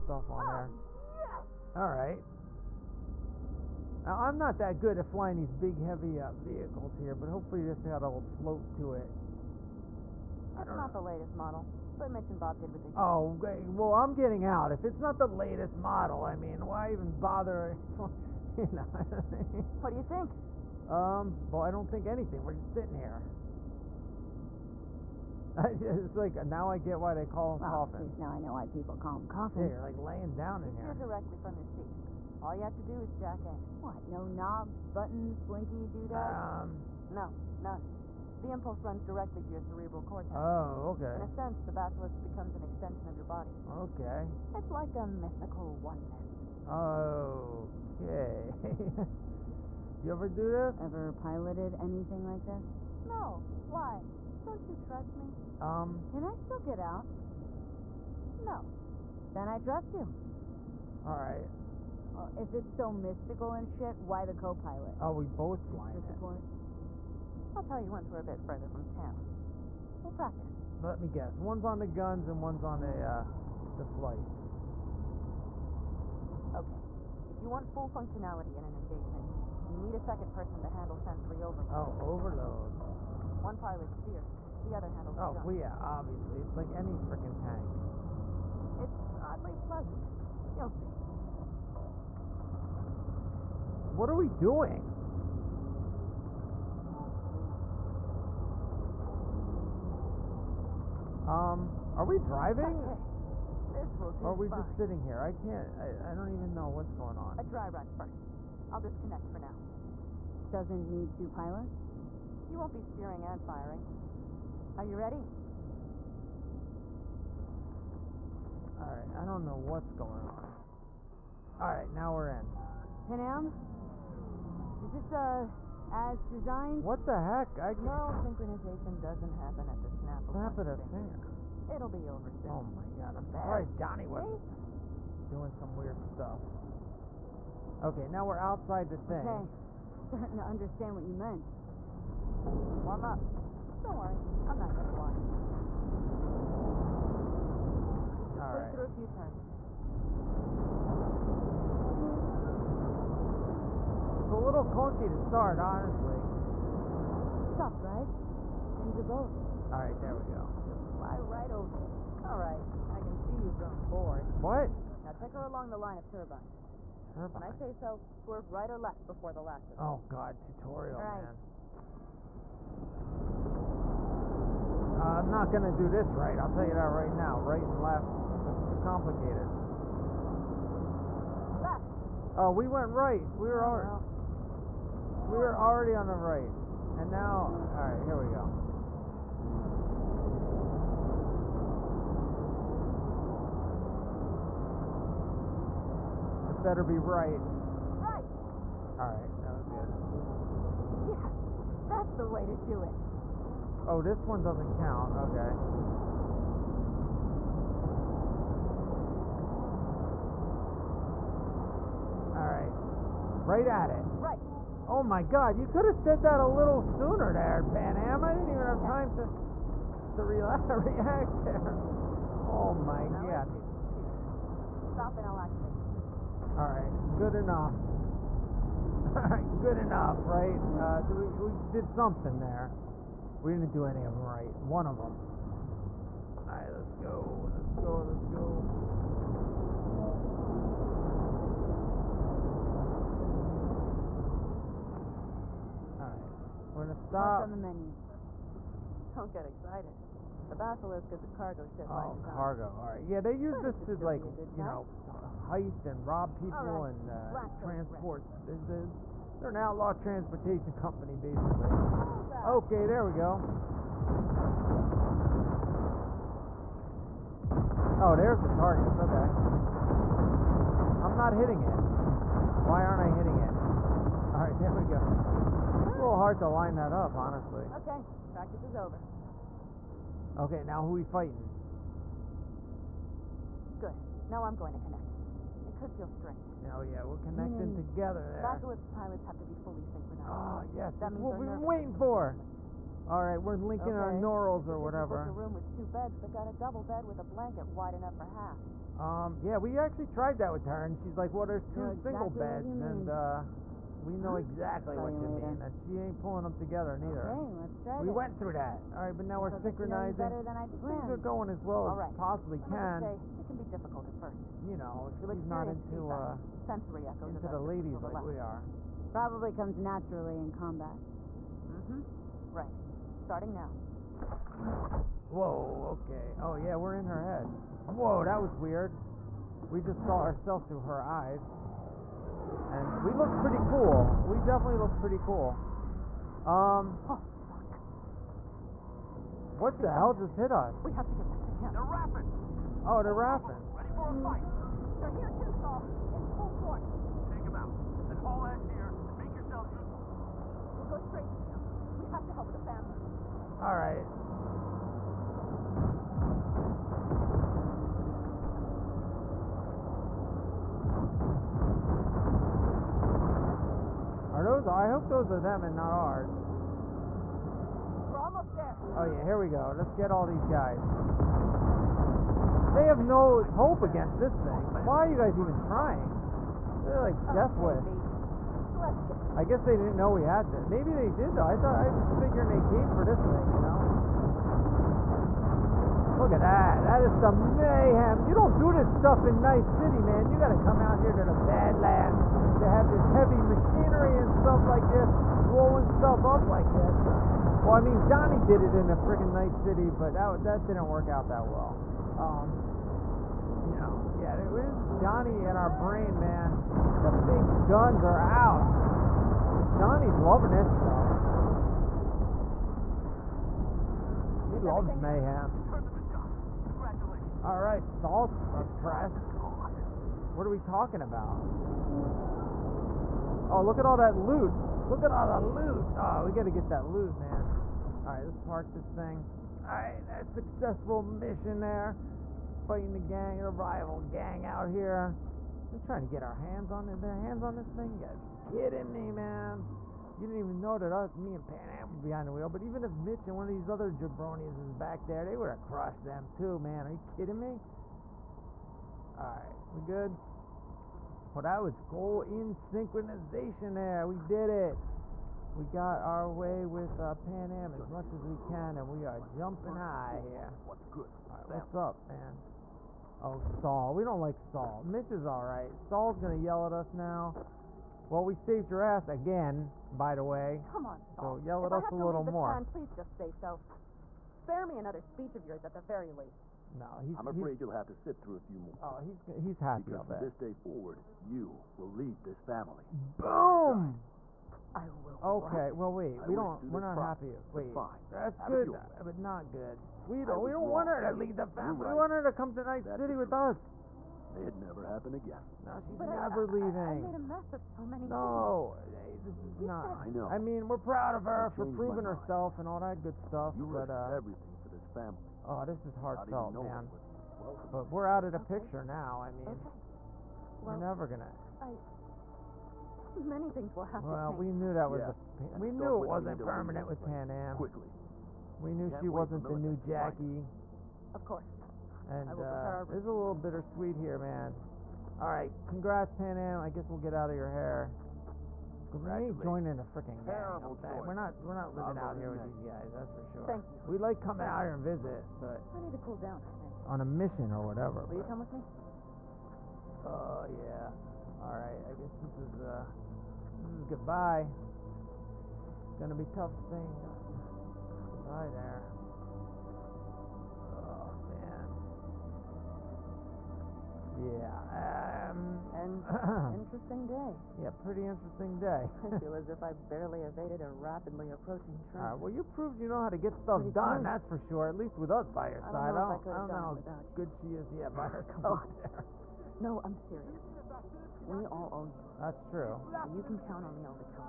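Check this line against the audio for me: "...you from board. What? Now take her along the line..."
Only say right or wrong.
right.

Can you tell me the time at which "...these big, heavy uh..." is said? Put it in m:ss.
0:05.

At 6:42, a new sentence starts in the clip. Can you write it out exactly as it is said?
Um, you know, yeah, this is Johnny in our brain, man.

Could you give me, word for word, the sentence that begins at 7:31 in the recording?
that was goal in synchronization there.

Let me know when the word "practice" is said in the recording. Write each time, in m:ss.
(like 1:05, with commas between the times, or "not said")
1:10, 4:38.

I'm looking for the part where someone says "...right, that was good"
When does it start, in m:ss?
3:19.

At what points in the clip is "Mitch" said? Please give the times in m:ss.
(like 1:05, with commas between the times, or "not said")
0:12, 7:23, 7:44.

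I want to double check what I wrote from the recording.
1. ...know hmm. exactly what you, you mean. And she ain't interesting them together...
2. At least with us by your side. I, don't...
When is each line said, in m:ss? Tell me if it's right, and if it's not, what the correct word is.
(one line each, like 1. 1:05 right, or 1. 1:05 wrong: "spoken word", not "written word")
1. 5:04 wrong: "pulling", not "interesting"
2. 9:24 right.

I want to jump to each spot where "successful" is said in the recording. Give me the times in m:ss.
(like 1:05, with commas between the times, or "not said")
7:10.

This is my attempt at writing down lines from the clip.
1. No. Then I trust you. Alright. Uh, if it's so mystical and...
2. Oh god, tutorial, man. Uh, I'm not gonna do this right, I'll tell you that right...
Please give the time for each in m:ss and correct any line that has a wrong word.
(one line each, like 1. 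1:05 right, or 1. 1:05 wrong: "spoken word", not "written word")
1. 0:58 right
2. 2:49 right.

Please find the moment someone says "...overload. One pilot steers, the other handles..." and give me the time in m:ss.
1:22.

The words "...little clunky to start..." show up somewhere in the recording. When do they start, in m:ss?
2:34.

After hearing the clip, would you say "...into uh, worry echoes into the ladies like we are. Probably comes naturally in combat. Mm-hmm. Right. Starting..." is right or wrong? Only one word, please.
wrong.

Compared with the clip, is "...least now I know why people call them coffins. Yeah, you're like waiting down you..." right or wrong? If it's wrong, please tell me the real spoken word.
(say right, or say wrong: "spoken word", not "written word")
wrong: "laying", not "waiting".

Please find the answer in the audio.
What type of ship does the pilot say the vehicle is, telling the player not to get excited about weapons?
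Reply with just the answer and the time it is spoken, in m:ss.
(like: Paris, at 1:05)
Cargo ship, at 4:11.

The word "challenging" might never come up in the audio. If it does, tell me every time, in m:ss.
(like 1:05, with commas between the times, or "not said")
not said.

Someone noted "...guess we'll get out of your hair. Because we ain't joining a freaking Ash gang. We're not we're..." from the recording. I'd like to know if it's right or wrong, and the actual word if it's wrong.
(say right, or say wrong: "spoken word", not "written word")
wrong: "Terrible", not "Ash".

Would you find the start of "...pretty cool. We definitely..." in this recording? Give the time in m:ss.
5:33.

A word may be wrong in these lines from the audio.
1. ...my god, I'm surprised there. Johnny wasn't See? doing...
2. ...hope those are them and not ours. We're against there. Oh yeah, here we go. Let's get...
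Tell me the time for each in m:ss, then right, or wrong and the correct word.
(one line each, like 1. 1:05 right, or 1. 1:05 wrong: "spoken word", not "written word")
1. 2:12 right
2. 6:04 wrong: "almost", not "against".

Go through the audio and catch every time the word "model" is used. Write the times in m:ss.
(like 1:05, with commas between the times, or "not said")
0:11, 0:15.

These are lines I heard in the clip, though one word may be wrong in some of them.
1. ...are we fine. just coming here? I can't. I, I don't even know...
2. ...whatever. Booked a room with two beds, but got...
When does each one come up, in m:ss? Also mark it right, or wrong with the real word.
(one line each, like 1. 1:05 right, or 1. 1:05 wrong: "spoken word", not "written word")
1. 1:44 wrong: "sitting", not "coming"
2. 4:54 right.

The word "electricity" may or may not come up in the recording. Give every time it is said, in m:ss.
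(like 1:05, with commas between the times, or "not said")
not said.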